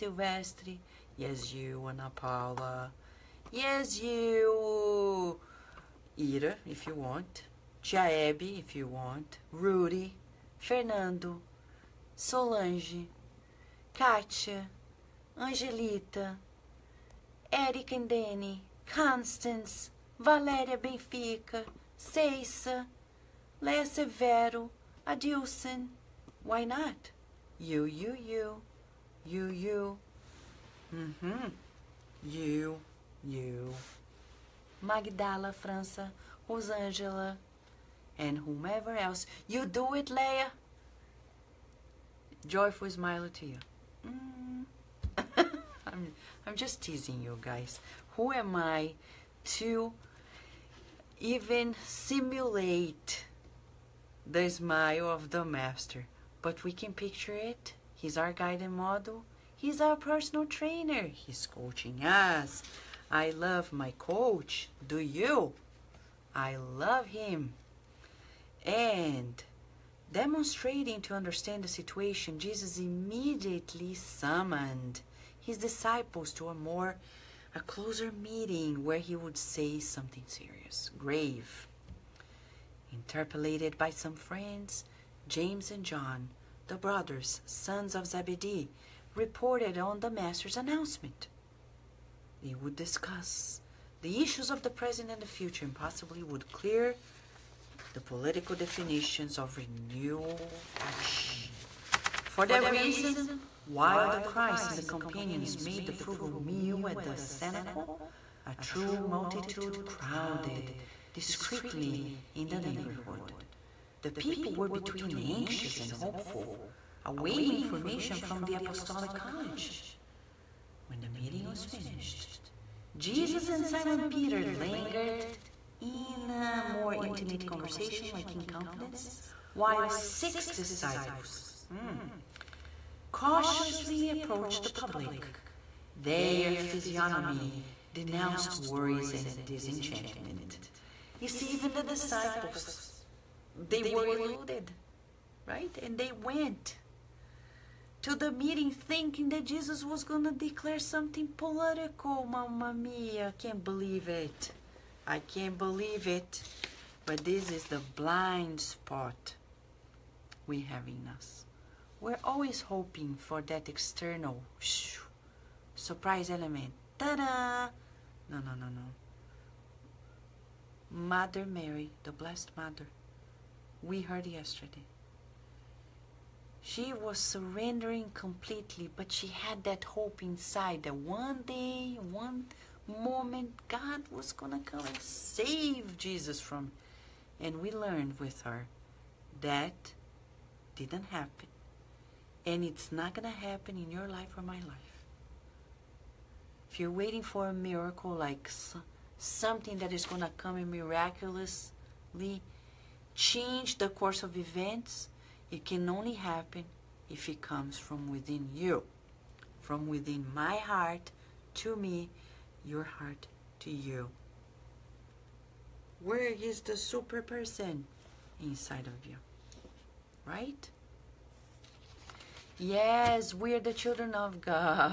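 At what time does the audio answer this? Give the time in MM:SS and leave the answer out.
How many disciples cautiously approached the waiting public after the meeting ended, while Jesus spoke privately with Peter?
02:09.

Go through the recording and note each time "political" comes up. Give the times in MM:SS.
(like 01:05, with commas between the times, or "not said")
01:38, 02:31.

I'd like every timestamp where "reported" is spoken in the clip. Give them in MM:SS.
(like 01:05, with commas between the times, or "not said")
01:29.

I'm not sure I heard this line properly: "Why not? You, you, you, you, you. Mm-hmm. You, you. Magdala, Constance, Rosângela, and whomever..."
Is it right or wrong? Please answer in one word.
wrong.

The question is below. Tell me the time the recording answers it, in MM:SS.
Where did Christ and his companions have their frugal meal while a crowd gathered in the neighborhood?
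01:47.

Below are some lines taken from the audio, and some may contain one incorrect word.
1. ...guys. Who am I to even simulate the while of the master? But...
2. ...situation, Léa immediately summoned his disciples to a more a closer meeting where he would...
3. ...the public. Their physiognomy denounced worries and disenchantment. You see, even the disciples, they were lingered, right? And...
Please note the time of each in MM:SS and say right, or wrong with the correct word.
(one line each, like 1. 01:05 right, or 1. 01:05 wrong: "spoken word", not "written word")
1. 00:47 wrong: "smile", not "while"
2. 01:11 wrong: "Jesus", not "Léa"
3. 02:14 wrong: "eluded", not "lingered".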